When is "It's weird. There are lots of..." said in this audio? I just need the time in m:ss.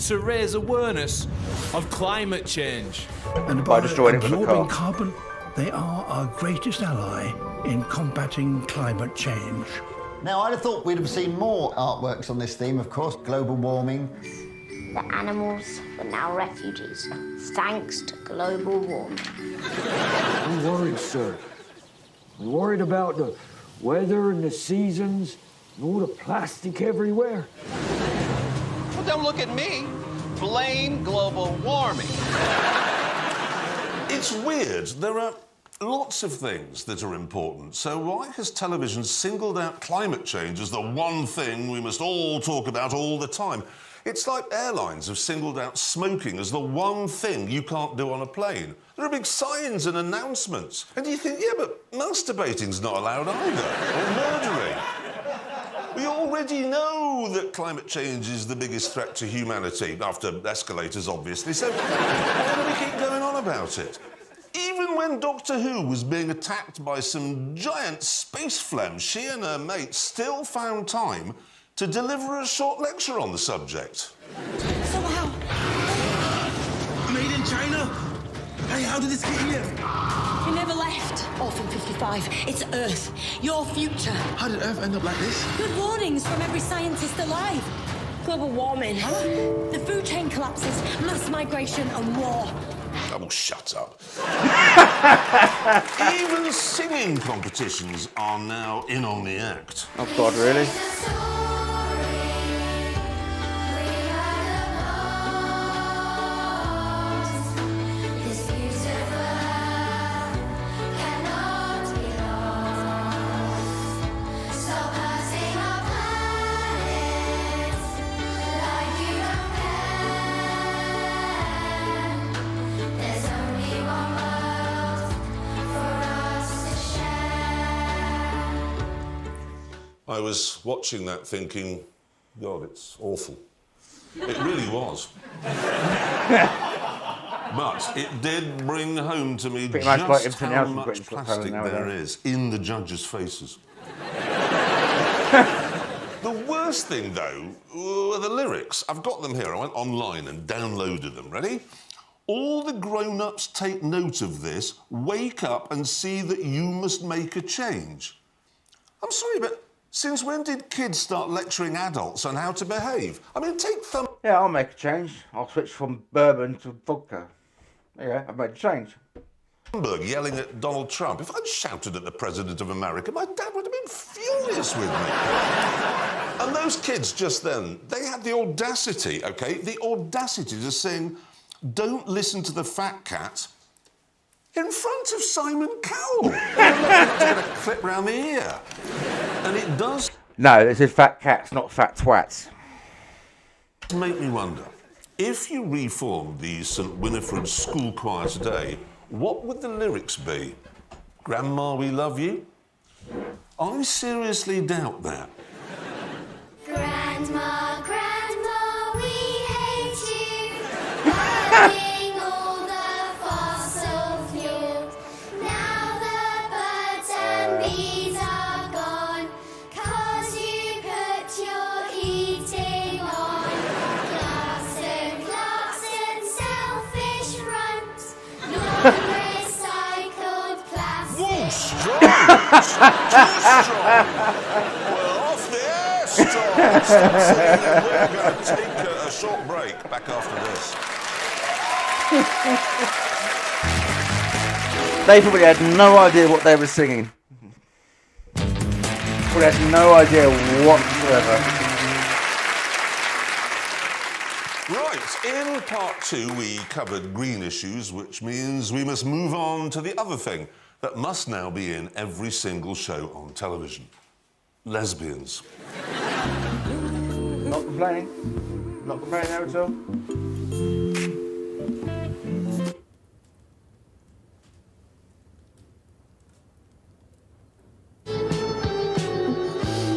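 0:34.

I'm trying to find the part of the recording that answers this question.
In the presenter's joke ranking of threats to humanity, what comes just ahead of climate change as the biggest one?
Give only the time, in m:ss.
1:00.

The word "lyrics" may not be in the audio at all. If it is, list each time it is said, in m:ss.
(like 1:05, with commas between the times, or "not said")
2:28, 3:19.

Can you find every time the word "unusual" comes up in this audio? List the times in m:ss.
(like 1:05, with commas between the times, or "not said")
not said.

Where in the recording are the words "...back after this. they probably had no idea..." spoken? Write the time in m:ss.
3:59.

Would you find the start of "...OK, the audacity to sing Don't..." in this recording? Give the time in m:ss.
2:59.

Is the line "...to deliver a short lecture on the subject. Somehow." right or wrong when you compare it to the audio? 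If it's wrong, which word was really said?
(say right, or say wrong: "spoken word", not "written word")
right.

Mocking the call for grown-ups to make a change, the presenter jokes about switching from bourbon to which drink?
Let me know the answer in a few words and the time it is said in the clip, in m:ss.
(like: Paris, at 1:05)
Vodka, at 2:46.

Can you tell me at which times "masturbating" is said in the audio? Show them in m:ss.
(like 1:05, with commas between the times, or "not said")
0:51.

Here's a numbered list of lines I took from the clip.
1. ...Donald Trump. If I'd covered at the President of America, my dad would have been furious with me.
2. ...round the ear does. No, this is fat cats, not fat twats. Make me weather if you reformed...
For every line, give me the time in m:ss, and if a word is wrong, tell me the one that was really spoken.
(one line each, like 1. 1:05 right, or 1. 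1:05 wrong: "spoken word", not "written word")
1. 2:50 wrong: "shouted", not "covered"
2. 3:07 wrong: "wonder", not "weather".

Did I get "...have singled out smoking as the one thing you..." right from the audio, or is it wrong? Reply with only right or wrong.
right.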